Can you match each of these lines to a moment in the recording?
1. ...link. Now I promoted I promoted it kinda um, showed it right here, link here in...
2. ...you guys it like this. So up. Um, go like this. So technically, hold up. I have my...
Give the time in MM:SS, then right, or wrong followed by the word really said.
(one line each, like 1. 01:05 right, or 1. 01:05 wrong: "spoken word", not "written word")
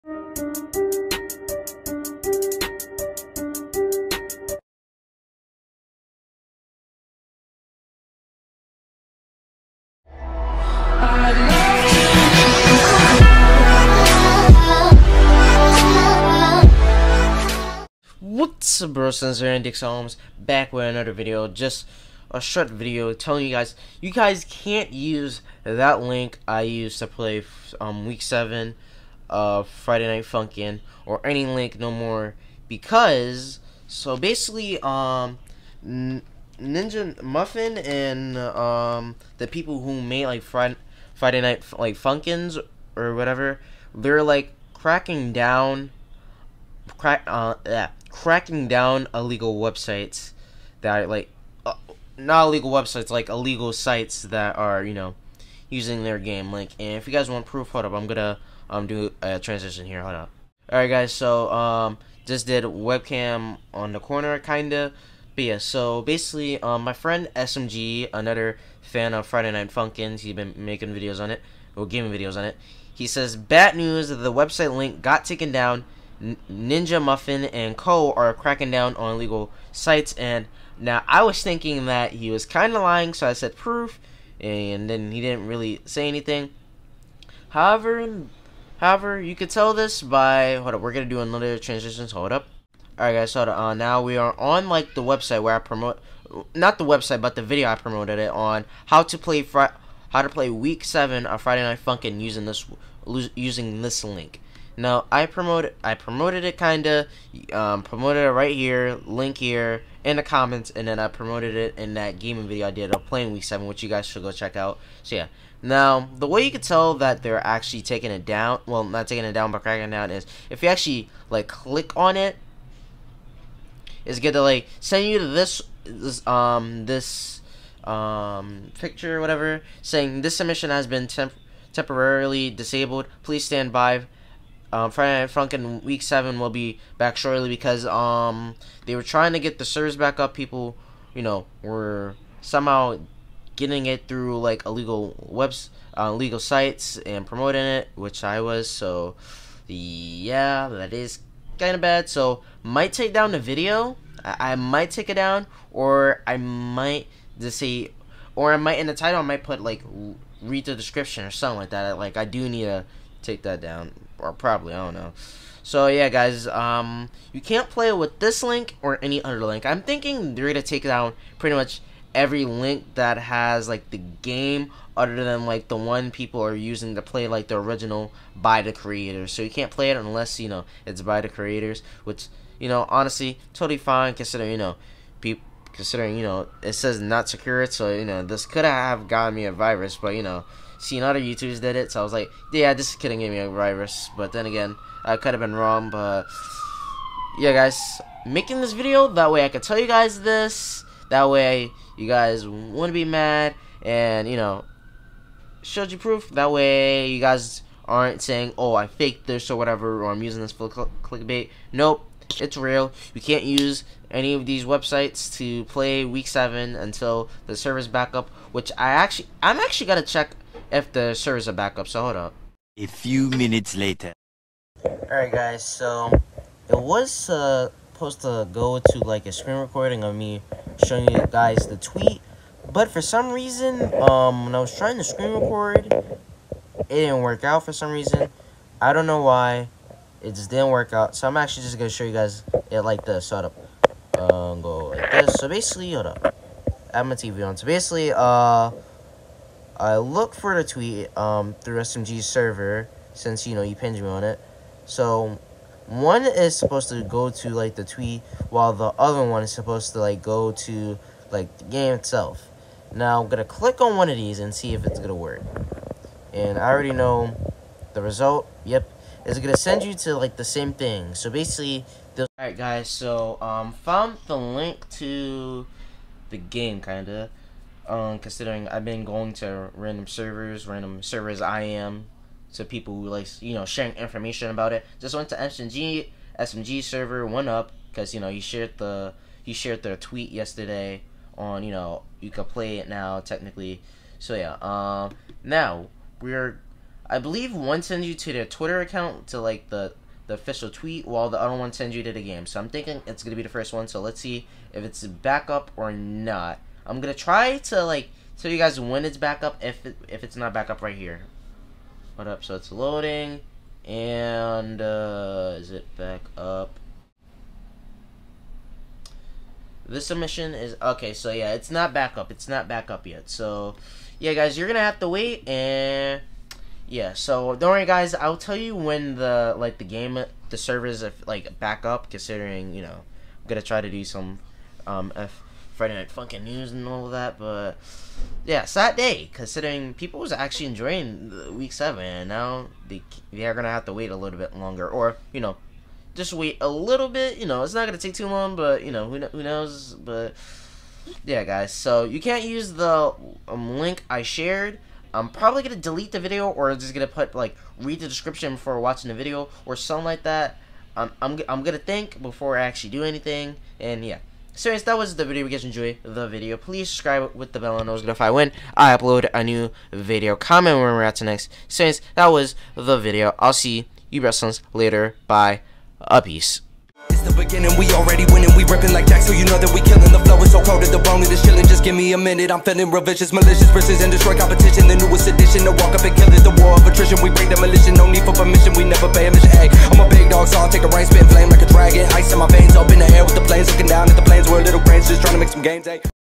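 1. 01:44 wrong: "promoted", not "showed"
2. 04:02 wrong: "basically", not "technically".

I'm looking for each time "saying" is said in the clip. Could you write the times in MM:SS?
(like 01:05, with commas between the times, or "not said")
02:09, 03:28.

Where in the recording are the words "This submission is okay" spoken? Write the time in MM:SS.
05:19.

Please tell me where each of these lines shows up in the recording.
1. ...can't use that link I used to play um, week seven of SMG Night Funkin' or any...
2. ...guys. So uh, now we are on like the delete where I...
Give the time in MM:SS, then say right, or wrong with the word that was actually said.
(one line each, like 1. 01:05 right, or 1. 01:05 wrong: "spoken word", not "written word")
1. 00:24 wrong: "Friday", not "SMG"
2. 01:33 wrong: "website", not "delete".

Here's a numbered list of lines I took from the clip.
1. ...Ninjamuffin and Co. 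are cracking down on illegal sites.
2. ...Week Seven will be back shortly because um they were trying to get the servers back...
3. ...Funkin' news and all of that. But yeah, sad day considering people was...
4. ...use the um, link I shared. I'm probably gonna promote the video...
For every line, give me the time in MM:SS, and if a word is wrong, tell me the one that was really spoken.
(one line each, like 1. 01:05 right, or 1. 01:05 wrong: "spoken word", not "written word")
1. 01:16 right
2. 02:15 right
3. 05:36 right
4. 05:52 wrong: "delete", not "promote".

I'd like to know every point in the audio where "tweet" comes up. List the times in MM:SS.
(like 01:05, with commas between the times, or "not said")
03:51, 04:10, 04:17, 04:49, 05:00.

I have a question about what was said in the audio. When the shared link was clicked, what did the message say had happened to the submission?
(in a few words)
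temporarily disabled.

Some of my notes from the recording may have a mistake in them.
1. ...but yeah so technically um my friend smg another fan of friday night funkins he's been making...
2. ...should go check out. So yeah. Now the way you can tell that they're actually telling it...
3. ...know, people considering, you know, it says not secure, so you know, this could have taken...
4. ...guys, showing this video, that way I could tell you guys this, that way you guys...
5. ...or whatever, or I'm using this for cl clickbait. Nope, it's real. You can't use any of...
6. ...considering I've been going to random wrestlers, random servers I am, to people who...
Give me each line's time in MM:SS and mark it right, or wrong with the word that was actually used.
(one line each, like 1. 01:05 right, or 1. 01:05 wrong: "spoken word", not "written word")
1. 01:05 wrong: "basically", not "technically"
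2. 01:54 wrong: "taking", not "telling"
3. 03:04 wrong: "gotten", not "taken"
4. 03:17 wrong: "making", not "showing"
5. 03:29 right
6. 04:38 wrong: "servers", not "wrestlers".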